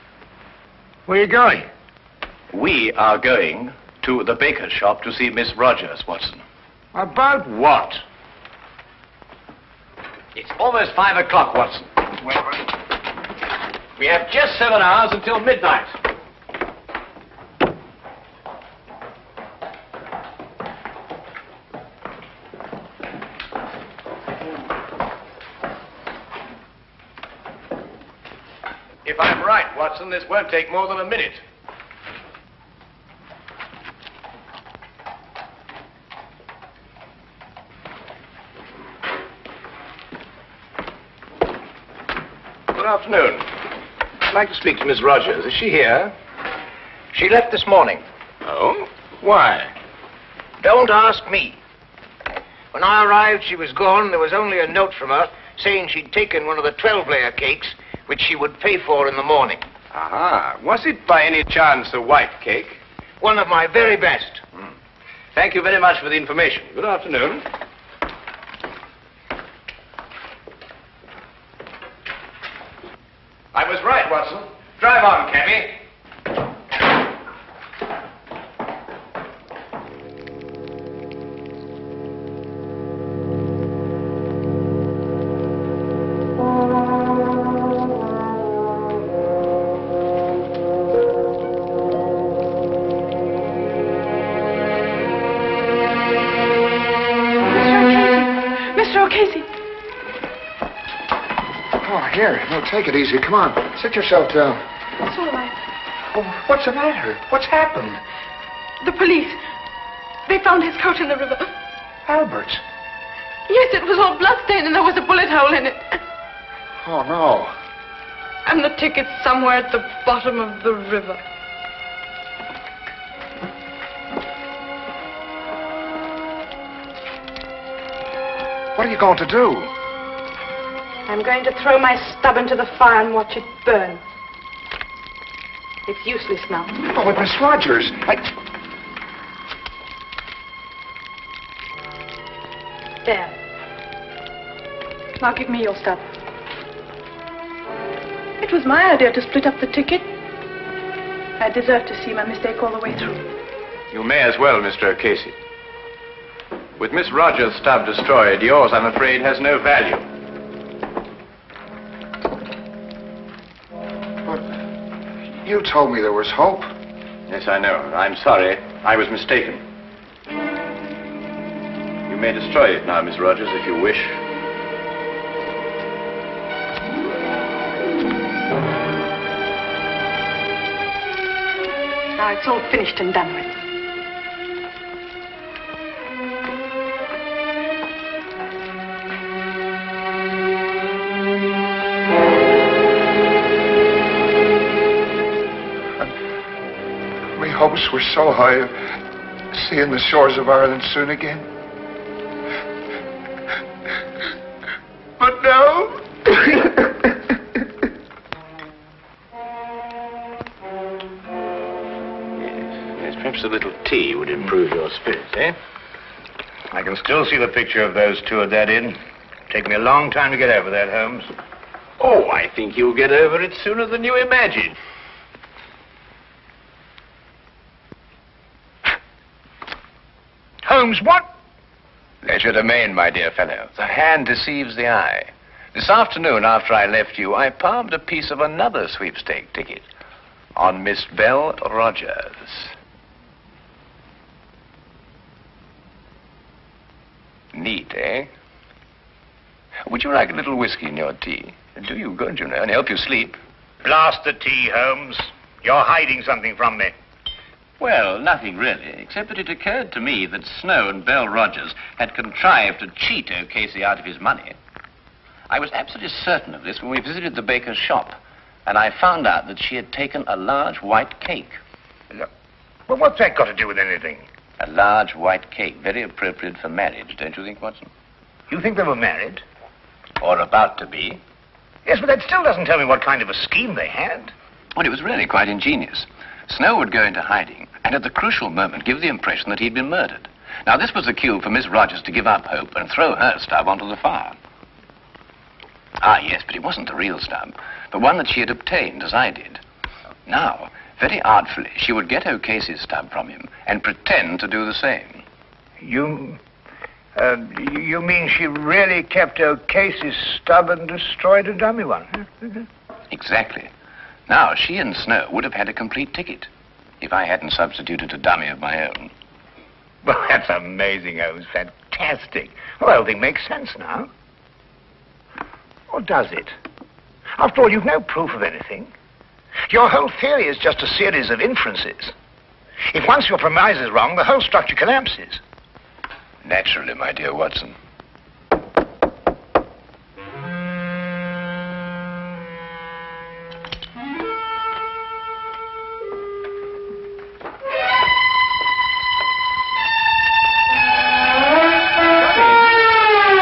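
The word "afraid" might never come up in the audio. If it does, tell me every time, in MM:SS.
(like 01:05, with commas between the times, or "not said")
02:38.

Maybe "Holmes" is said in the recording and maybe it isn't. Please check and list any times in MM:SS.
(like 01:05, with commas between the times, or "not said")
03:40, 03:50, 04:14, 05:21.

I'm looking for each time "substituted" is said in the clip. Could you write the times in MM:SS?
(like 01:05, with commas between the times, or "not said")
05:17.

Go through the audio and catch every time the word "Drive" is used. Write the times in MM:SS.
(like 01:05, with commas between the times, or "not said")
01:14.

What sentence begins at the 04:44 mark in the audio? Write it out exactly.
Well, it was really quite ingenious.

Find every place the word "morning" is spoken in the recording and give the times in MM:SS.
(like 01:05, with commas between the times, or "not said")
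00:47, 00:59.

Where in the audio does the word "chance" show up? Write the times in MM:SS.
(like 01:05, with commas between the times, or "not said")
01:01.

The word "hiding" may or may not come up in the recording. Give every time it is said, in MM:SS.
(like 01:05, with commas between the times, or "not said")
04:15, 04:47.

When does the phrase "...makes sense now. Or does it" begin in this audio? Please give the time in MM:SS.
05:23.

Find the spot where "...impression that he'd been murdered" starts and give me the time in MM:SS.
04:49.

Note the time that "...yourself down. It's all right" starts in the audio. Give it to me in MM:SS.
01:43.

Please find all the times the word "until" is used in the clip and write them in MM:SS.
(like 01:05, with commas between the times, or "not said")
00:15.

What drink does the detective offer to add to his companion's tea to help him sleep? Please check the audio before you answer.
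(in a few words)
Whiskey.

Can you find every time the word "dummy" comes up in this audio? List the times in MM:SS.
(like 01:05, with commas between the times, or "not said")
05:11, 05:18.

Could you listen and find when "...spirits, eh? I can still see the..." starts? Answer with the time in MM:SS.
03:34.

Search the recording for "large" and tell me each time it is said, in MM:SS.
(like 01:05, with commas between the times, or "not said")
04:30, 04:34.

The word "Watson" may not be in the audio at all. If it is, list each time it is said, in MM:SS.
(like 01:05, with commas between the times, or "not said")
00:06, 00:11, 00:30, 01:14, 04:37, 05:37.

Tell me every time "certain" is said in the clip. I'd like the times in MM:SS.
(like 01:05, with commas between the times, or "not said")
04:26.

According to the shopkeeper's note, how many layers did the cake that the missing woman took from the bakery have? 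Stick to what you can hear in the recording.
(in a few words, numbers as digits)
12.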